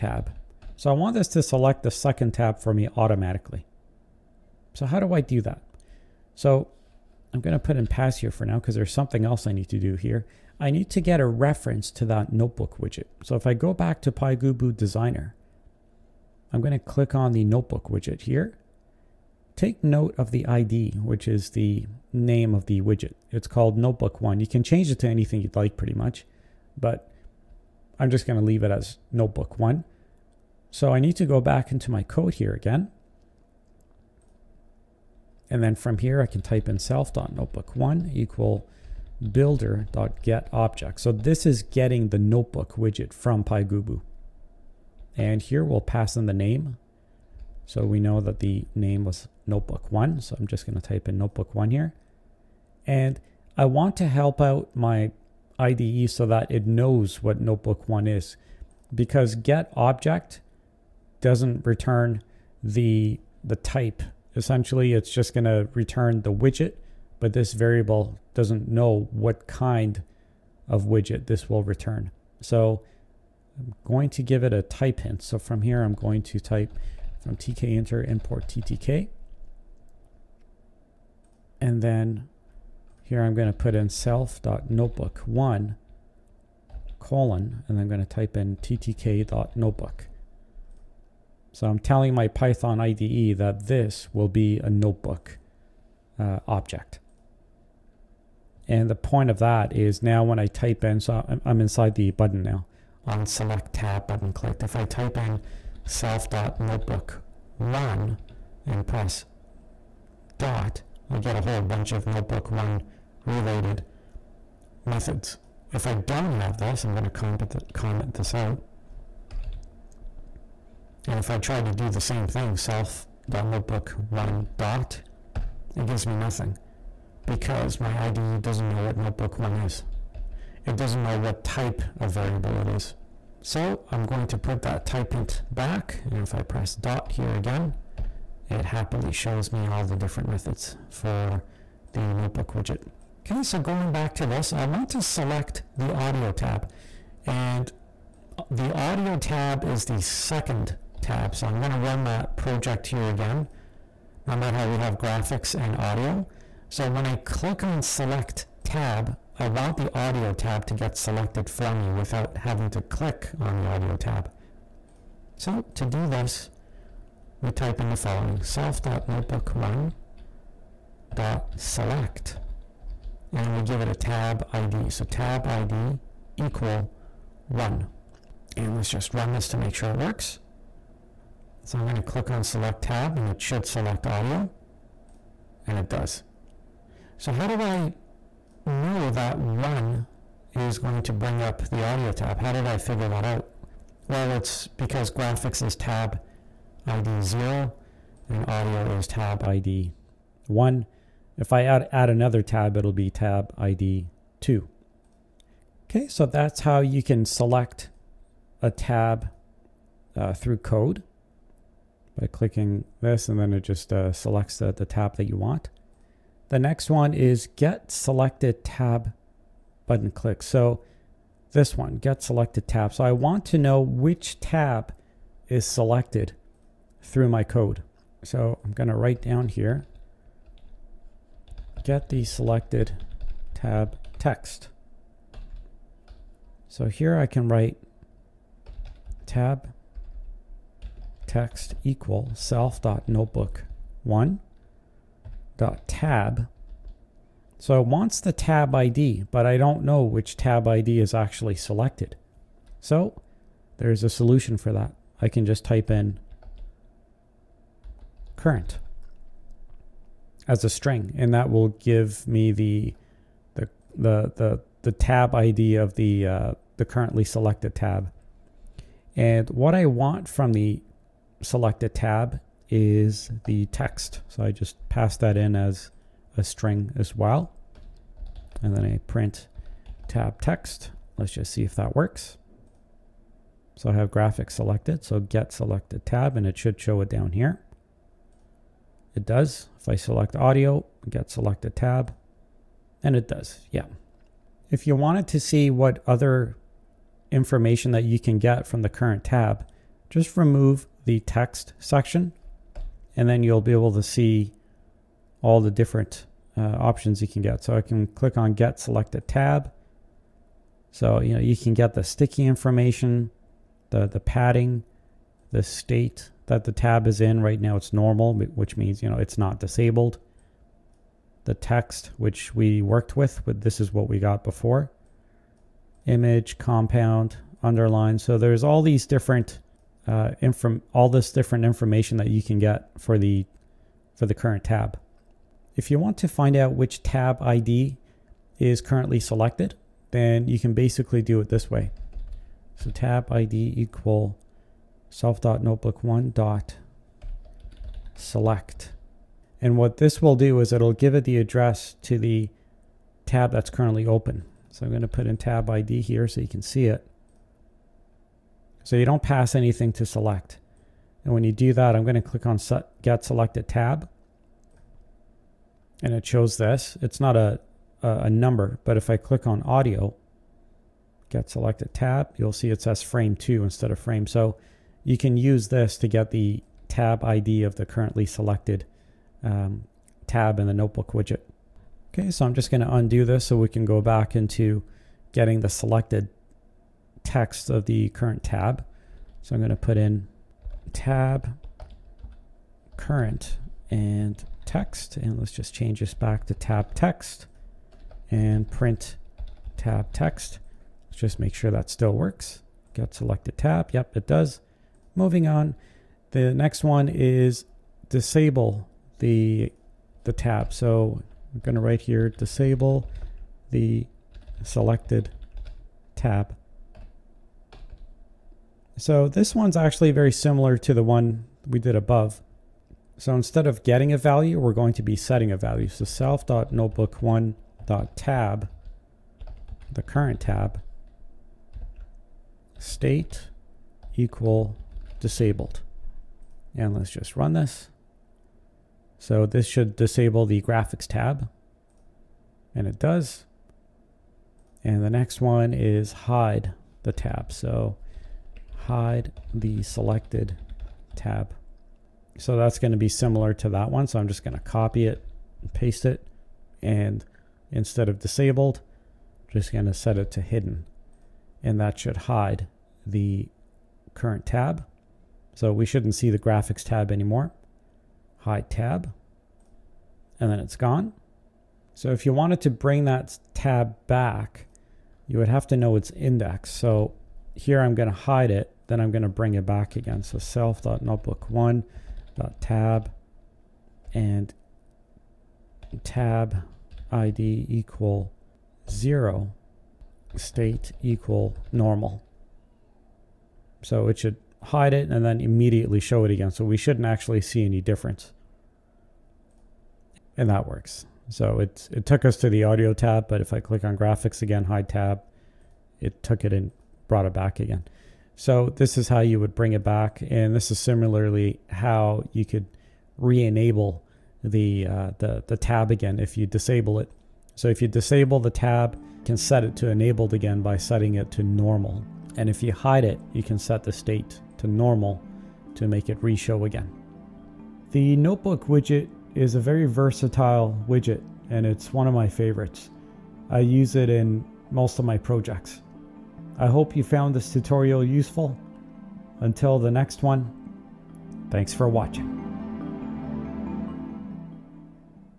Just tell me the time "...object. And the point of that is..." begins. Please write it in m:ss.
1:36.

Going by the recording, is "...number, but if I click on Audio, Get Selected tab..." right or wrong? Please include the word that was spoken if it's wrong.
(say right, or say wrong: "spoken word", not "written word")
right.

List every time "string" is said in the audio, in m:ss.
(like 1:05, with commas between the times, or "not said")
4:20, 4:36.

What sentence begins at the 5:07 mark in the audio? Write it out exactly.
So I can click on get select a tab.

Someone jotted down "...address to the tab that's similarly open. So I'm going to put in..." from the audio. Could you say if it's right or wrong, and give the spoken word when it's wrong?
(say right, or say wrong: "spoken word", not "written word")
wrong: "currently", not "similarly".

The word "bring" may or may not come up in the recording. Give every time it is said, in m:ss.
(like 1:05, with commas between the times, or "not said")
3:11, 7:52, 7:59, 8:29.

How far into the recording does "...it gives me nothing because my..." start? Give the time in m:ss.
2:05.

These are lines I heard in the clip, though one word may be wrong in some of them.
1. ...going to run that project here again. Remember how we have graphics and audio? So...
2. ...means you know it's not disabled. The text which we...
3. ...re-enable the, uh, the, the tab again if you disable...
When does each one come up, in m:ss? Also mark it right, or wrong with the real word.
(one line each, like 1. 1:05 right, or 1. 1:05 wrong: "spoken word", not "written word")
1. 2:31 right
2. 5:18 right
3. 8:33 right.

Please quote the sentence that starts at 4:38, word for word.
And then I print tab text.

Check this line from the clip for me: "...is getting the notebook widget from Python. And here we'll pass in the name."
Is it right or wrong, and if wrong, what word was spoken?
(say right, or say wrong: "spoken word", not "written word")
wrong: "PyGubu", not "Python".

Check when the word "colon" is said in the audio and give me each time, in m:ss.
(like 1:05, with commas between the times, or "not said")
1:26.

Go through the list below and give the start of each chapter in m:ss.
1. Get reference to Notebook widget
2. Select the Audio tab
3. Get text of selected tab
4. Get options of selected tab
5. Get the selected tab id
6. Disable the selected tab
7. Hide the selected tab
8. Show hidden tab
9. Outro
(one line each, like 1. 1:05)
1. 0:09
2. 2:22
3. 3:35
4. 4:53
5. 5:34
6. 6:44
7. 7:23
8. 7:51
9. 8:27.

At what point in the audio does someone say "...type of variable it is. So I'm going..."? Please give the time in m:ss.
2:11.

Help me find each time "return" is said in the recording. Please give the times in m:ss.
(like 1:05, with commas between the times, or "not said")
1:01, 1:05, 1:11.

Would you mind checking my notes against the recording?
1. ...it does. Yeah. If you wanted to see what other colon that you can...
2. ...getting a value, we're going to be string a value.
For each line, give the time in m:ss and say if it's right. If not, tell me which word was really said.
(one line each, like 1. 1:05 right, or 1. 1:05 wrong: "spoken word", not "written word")
1. 4:53 wrong: "information", not "colon"
2. 7:03 wrong: "setting", not "string".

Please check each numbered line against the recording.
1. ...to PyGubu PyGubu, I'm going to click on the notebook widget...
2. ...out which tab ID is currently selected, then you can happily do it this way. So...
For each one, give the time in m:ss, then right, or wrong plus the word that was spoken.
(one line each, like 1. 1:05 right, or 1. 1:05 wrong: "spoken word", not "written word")
1. 0:14 wrong: "Designer", not "PyGubu"
2. 5:36 wrong: "basically", not "happily".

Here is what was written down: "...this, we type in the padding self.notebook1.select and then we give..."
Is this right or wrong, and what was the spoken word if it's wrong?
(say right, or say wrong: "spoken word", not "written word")
wrong: "following", not "padding".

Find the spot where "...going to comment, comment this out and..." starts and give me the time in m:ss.
1:56.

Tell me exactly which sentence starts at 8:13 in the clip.
So it should hide it and then immediately show it again.